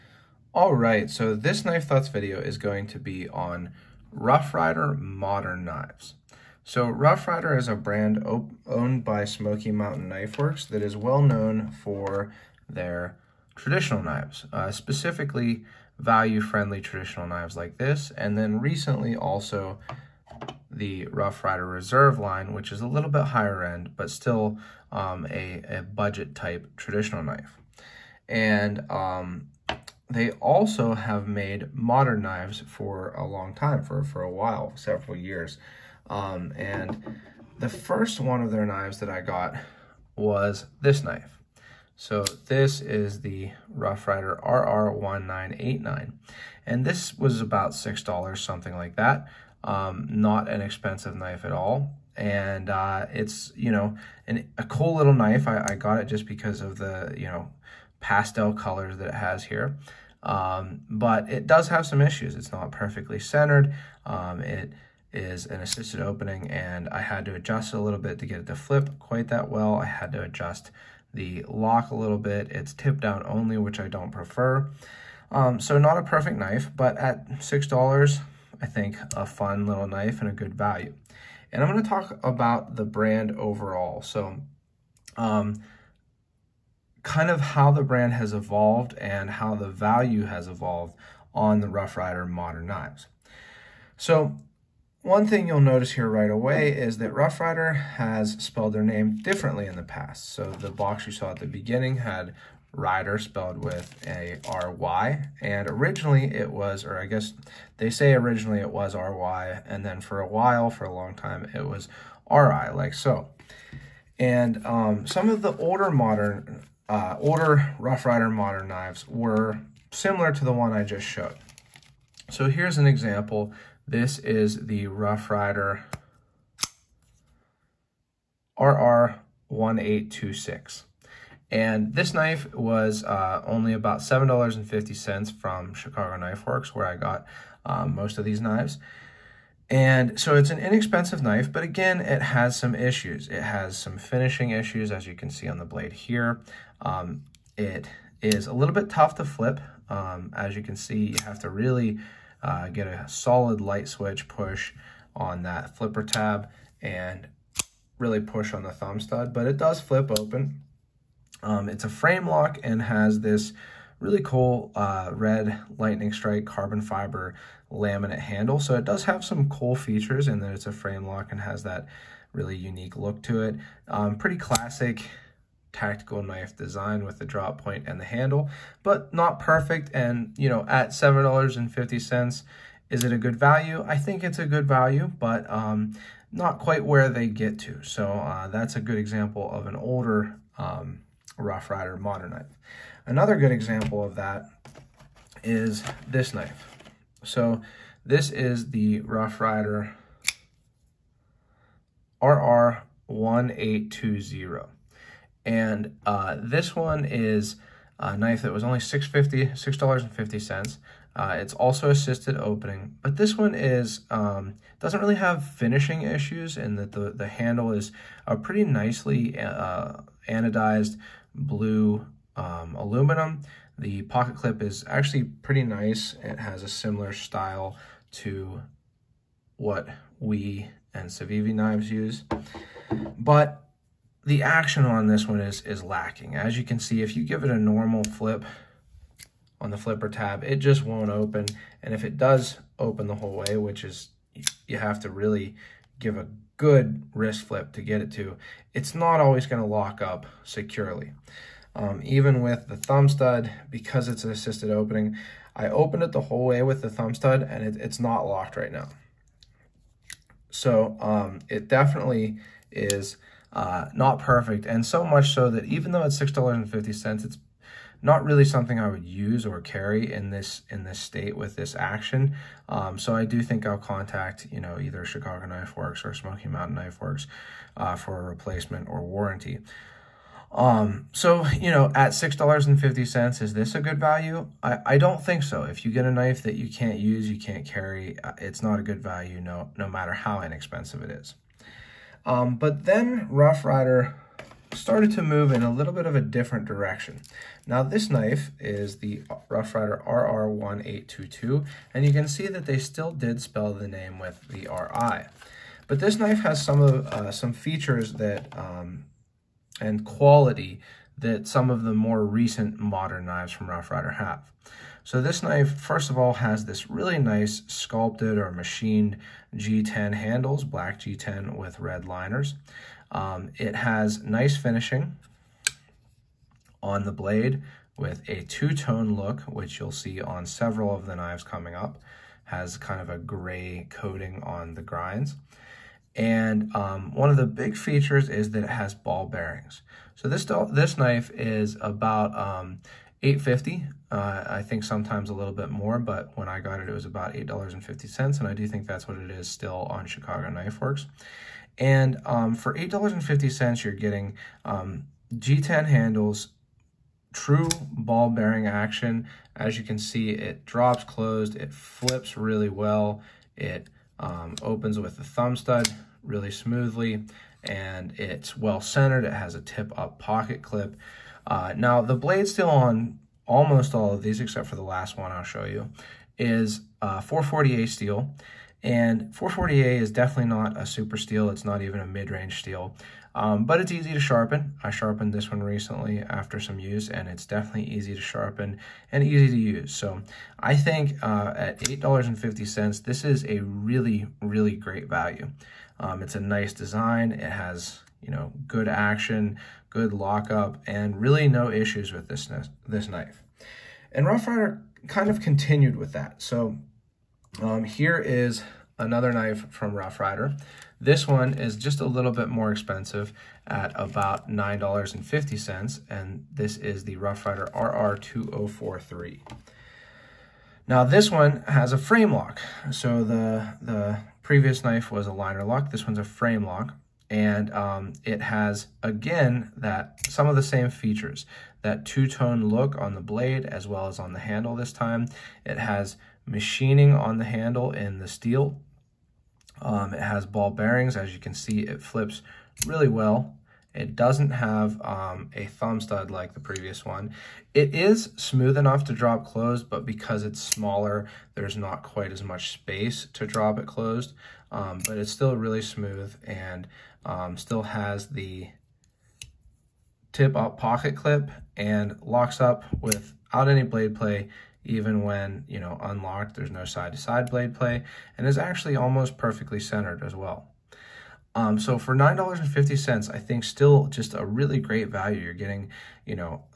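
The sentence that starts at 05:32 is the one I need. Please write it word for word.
Has kind of a gray coating on the grinds.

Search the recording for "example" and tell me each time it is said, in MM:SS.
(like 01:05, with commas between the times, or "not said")
02:02, 03:08, 03:13.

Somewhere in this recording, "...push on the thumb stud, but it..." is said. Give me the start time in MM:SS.
02:38.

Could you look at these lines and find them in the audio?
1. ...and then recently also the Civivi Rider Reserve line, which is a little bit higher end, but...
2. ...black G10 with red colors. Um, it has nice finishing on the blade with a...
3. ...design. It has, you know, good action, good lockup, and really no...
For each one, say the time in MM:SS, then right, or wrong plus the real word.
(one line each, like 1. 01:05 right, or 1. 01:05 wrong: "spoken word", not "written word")
1. 00:18 wrong: "Rough", not "Civivi"
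2. 05:20 wrong: "liners", not "colors"
3. 06:36 right.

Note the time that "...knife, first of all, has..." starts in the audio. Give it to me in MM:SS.
05:15.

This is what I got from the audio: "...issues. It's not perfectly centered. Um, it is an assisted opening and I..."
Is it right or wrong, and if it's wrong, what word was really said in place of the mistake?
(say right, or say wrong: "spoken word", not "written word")
right.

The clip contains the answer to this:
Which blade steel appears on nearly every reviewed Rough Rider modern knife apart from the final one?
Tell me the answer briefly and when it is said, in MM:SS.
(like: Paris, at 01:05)
440A, at 06:17.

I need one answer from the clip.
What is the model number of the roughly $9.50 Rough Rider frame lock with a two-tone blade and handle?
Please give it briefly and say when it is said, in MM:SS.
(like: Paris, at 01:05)
RR2043, at 06:57.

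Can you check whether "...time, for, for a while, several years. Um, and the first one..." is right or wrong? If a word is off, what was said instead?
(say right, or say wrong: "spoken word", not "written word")
right.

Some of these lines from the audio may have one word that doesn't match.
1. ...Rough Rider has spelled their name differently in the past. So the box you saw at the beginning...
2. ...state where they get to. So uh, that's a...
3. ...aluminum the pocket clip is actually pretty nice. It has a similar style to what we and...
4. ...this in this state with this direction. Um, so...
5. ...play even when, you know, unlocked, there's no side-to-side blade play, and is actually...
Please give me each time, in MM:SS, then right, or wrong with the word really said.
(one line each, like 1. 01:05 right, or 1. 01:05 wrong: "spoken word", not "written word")
1. 01:37 right
2. 03:06 wrong: "quite", not "state"
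3. 03:42 right
4. 04:30 wrong: "action", not "direction"
5. 07:44 right.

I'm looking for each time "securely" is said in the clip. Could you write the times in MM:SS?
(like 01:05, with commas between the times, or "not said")
04:10.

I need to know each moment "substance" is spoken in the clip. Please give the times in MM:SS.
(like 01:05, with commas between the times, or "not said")
not said.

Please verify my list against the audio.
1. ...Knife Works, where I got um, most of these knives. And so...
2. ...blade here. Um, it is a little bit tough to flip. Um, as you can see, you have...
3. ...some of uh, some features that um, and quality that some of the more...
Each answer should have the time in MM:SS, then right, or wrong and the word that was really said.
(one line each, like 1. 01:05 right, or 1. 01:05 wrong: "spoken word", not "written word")
1. 02:16 right
2. 02:25 right
3. 05:06 right.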